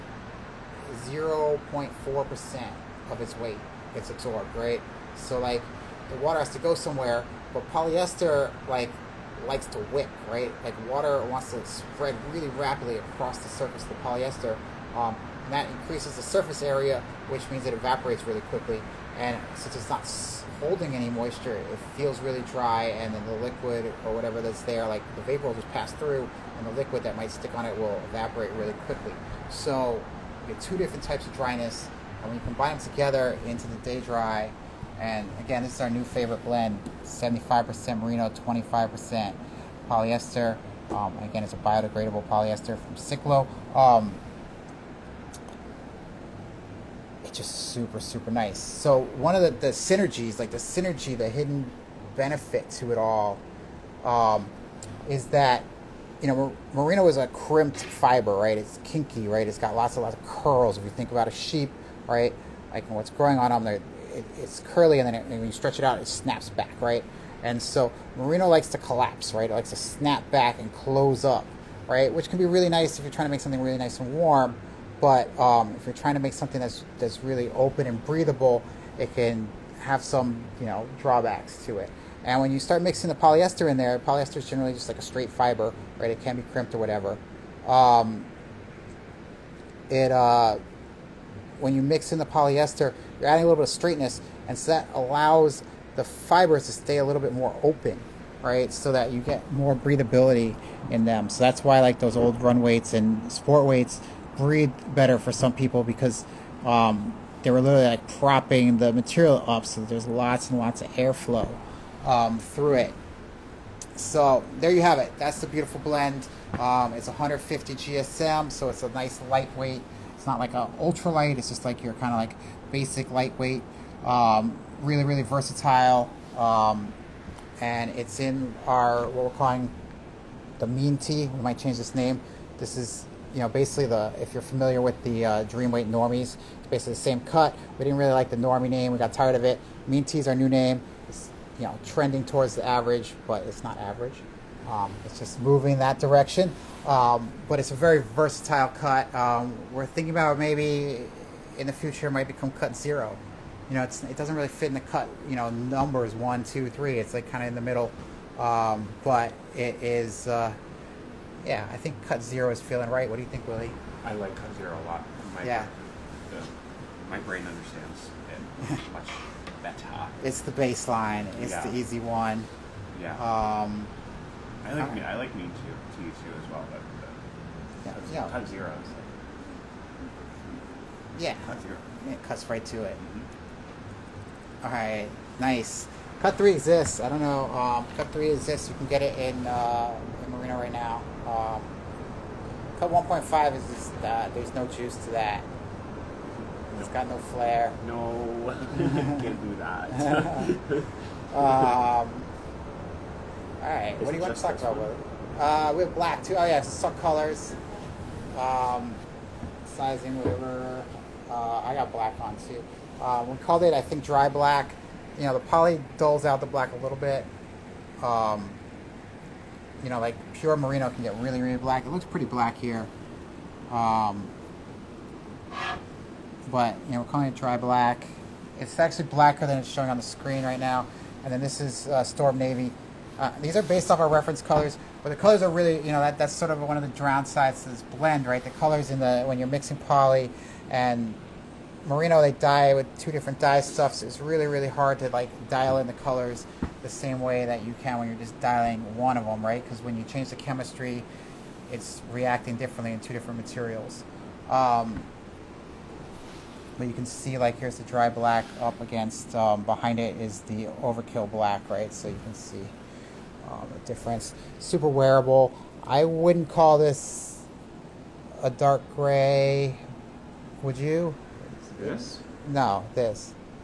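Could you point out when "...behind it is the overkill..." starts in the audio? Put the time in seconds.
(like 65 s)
259 s.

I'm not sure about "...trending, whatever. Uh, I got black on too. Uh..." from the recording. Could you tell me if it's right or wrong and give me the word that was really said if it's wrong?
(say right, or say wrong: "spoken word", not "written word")
wrong: "sizing", not "trending".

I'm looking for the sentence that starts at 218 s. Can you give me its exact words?
Um, you know, like pure merino can get really, really black.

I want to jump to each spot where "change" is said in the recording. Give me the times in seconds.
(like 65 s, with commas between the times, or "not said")
131 s, 250 s.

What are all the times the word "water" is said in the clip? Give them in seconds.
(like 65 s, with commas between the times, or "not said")
6 s, 10 s.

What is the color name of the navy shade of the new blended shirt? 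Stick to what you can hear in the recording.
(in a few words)
Storm Navy.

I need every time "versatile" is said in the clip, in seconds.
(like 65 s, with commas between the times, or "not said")
125 s, 148 s.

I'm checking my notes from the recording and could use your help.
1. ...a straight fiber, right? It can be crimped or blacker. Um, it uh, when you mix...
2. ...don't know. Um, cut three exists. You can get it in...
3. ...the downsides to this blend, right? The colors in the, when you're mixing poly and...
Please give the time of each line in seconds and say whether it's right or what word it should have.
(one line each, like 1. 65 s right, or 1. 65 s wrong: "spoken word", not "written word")
1. 84 s wrong: "whatever", not "blacker"
2. 187 s right
3. 236 s right.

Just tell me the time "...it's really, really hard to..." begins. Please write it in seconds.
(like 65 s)
244 s.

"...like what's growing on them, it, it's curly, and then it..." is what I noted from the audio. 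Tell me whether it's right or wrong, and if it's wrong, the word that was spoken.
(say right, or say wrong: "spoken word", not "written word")
right.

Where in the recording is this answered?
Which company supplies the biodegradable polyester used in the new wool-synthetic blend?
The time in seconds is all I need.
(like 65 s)
42 s.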